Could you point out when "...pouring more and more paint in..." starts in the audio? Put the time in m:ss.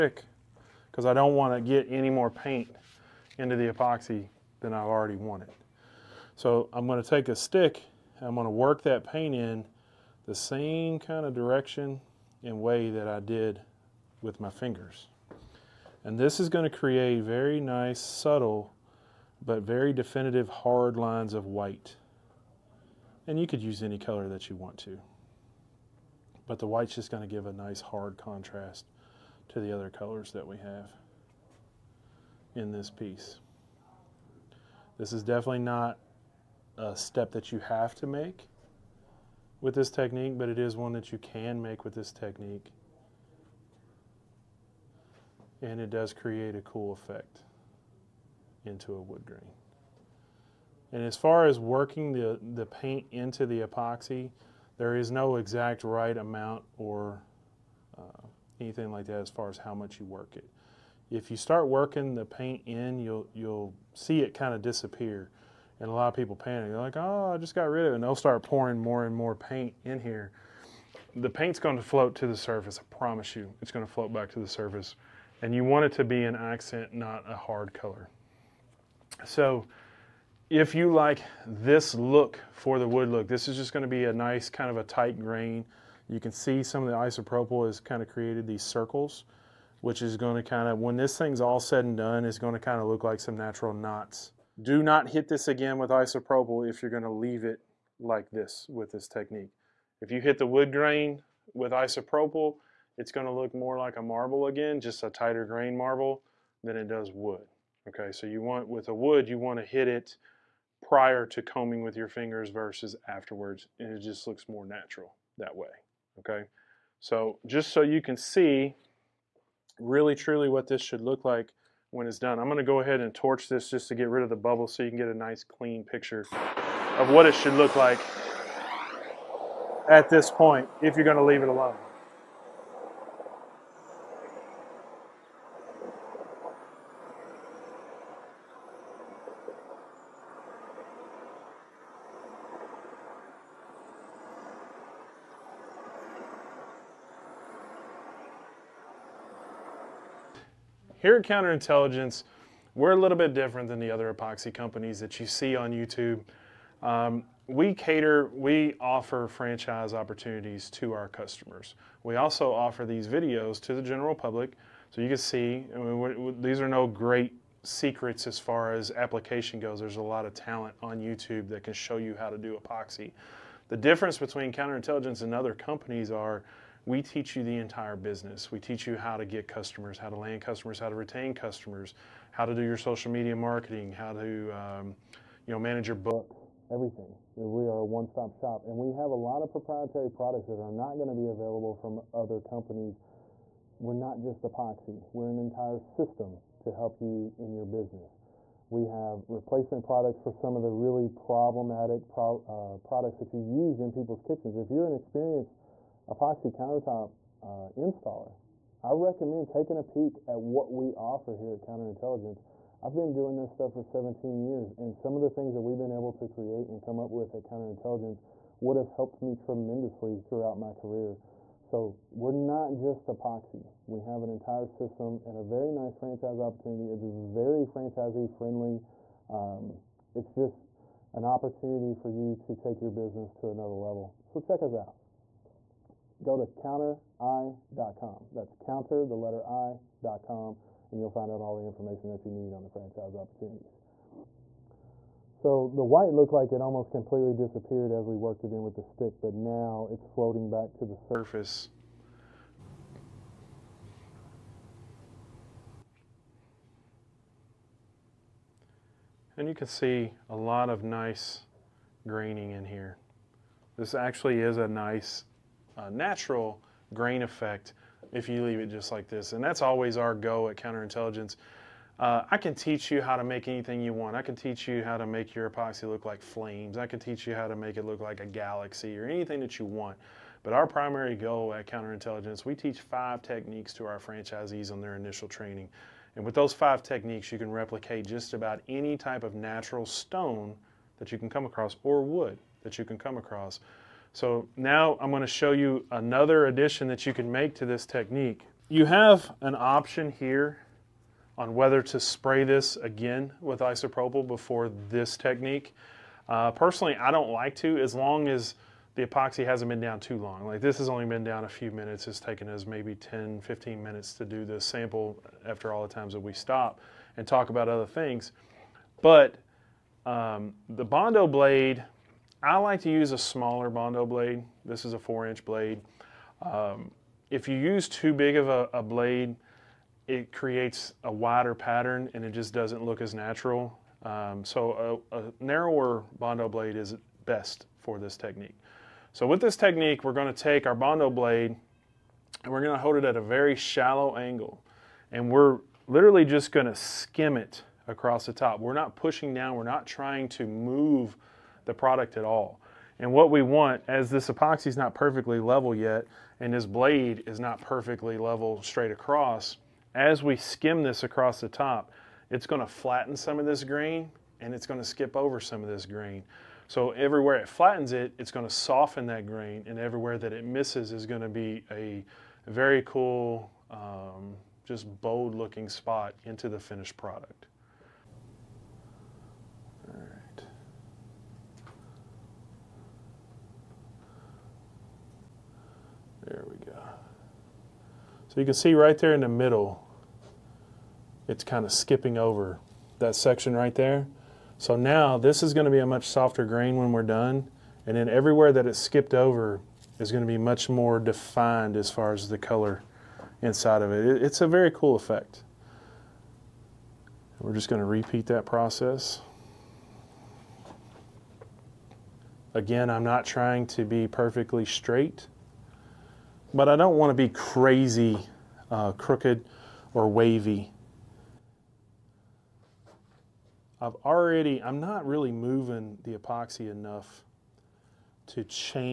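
1:08.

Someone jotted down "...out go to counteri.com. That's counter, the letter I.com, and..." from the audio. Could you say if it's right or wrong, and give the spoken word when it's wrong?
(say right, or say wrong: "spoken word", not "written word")
right.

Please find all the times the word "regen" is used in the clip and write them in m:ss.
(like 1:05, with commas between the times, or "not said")
not said.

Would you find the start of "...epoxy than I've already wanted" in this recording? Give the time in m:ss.
0:03.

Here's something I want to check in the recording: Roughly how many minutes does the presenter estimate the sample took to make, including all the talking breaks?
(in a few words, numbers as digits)
10 to 15 minutes.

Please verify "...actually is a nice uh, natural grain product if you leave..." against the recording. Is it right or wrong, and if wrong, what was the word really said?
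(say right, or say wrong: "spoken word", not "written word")
wrong: "effect", not "product".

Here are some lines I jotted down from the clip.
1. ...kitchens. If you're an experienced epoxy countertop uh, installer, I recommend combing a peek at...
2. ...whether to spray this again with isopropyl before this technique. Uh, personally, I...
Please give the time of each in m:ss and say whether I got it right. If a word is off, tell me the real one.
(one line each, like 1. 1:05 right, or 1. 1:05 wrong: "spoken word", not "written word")
1. 3:24 wrong: "taking", not "combing"
2. 5:01 right.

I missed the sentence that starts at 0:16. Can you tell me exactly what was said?
And this is going to create very nice, subtle, but very definitive hard lines of white.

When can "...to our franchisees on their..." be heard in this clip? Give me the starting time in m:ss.
4:43.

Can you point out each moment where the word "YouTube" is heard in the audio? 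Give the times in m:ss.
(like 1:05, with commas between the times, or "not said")
2:35, 2:50.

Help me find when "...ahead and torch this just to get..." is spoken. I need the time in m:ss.
2:02.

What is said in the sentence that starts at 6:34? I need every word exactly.
So now this is going to be a much softer grain when we're done.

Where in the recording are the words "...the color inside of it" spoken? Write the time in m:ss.
6:42.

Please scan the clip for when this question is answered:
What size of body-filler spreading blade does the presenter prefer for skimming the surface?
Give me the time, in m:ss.
5:24.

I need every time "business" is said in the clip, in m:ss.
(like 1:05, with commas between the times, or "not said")
2:57, 3:17, 3:52.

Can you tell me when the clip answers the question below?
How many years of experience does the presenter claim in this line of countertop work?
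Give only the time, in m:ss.
3:33.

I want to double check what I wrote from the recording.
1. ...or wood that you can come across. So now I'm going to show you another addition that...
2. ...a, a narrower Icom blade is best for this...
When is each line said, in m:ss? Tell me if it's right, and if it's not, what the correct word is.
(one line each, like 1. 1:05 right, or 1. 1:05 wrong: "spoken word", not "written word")
1. 4:51 right
2. 5:35 wrong: "Bondo", not "Icom".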